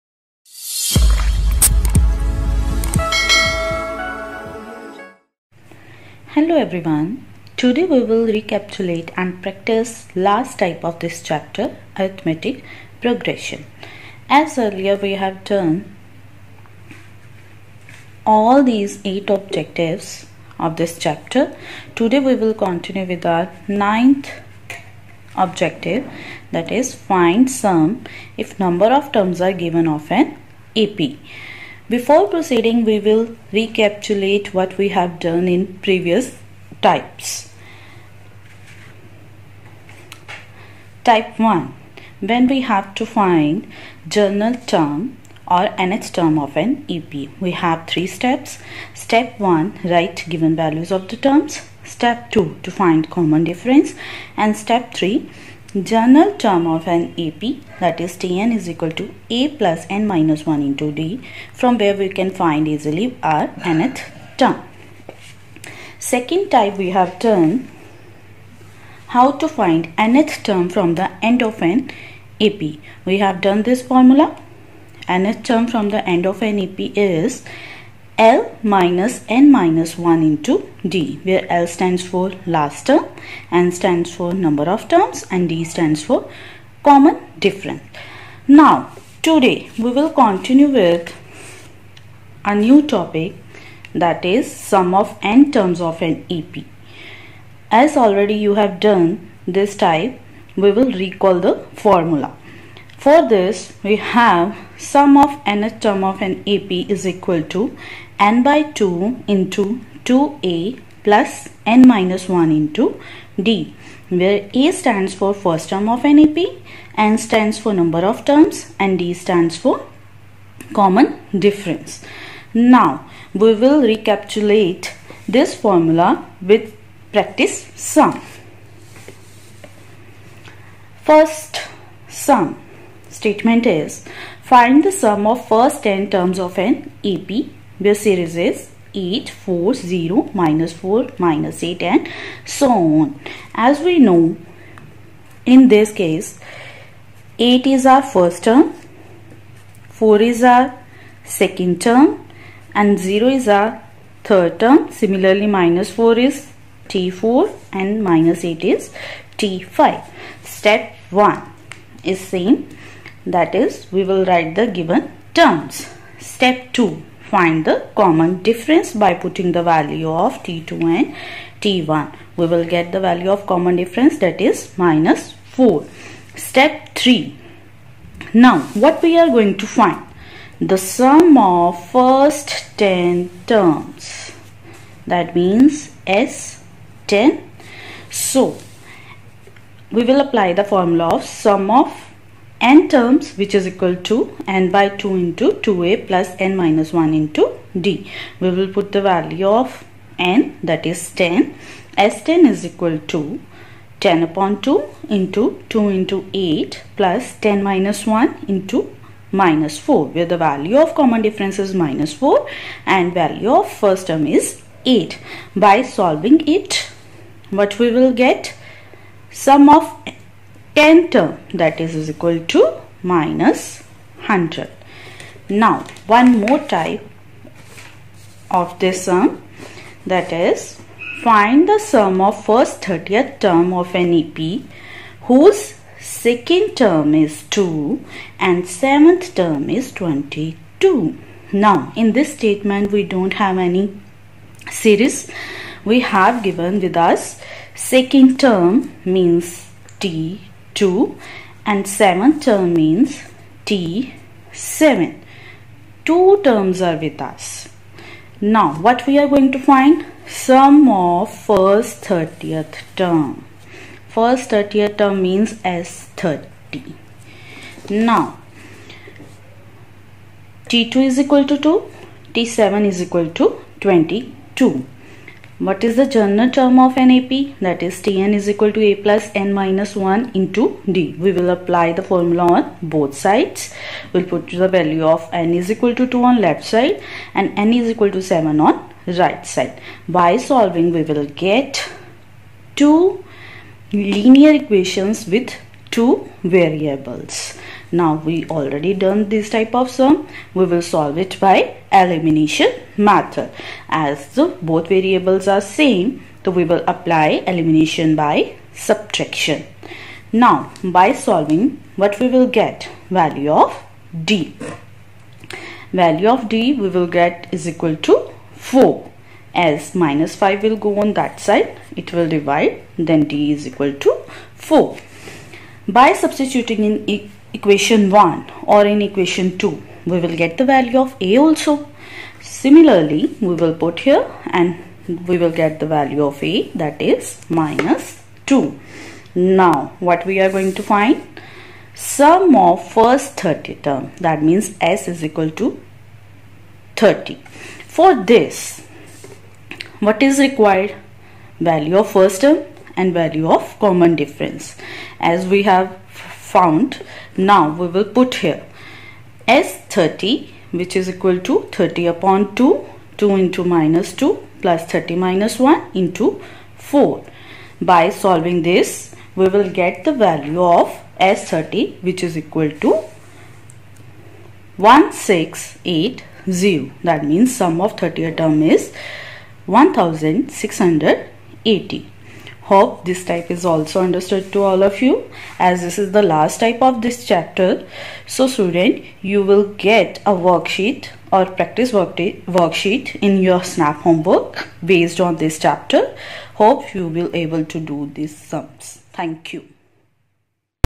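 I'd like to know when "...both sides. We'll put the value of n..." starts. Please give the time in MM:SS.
04:42.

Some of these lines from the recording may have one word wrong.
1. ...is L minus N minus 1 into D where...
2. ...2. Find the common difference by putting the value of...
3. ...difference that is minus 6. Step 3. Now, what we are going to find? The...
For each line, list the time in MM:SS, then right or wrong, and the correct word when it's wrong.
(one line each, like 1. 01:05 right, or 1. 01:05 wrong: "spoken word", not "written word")
1. 01:16 right
2. 02:46 right
3. 02:53 wrong: "4", not "6".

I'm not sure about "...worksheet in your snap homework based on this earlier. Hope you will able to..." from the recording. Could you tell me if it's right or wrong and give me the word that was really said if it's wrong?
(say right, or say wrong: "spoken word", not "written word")
wrong: "chapter", not "earlier".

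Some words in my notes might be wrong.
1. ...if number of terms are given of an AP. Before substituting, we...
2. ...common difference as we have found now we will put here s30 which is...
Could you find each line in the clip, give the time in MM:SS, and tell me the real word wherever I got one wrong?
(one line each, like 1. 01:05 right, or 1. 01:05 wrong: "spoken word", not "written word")
1. 00:28 wrong: "proceeding", not "substituting"
2. 05:53 right.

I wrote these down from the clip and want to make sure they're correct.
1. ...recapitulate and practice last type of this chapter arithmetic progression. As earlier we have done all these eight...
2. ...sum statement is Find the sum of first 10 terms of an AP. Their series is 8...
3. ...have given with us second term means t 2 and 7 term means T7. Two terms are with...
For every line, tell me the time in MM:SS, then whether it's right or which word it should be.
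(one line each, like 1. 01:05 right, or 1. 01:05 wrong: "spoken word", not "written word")
1. 00:08 right
2. 02:12 right
3. 04:05 right.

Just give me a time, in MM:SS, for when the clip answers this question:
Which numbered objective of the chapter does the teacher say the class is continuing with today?
00:23.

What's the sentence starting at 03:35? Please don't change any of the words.
By solving it what we will get sum of 10 term that is, is equal to minus 100.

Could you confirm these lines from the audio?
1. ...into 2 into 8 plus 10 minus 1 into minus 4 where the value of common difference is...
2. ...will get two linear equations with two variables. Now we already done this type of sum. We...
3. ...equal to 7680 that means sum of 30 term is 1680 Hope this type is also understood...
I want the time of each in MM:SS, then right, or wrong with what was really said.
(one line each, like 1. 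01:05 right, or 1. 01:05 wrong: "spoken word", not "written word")
1. 03:25 right
2. 04:51 right
3. 06:12 wrong: "1680", not "7680".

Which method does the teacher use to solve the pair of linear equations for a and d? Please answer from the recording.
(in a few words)
Elimination by subtraction.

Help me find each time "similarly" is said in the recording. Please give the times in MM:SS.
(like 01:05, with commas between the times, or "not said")
02:34, 05:32.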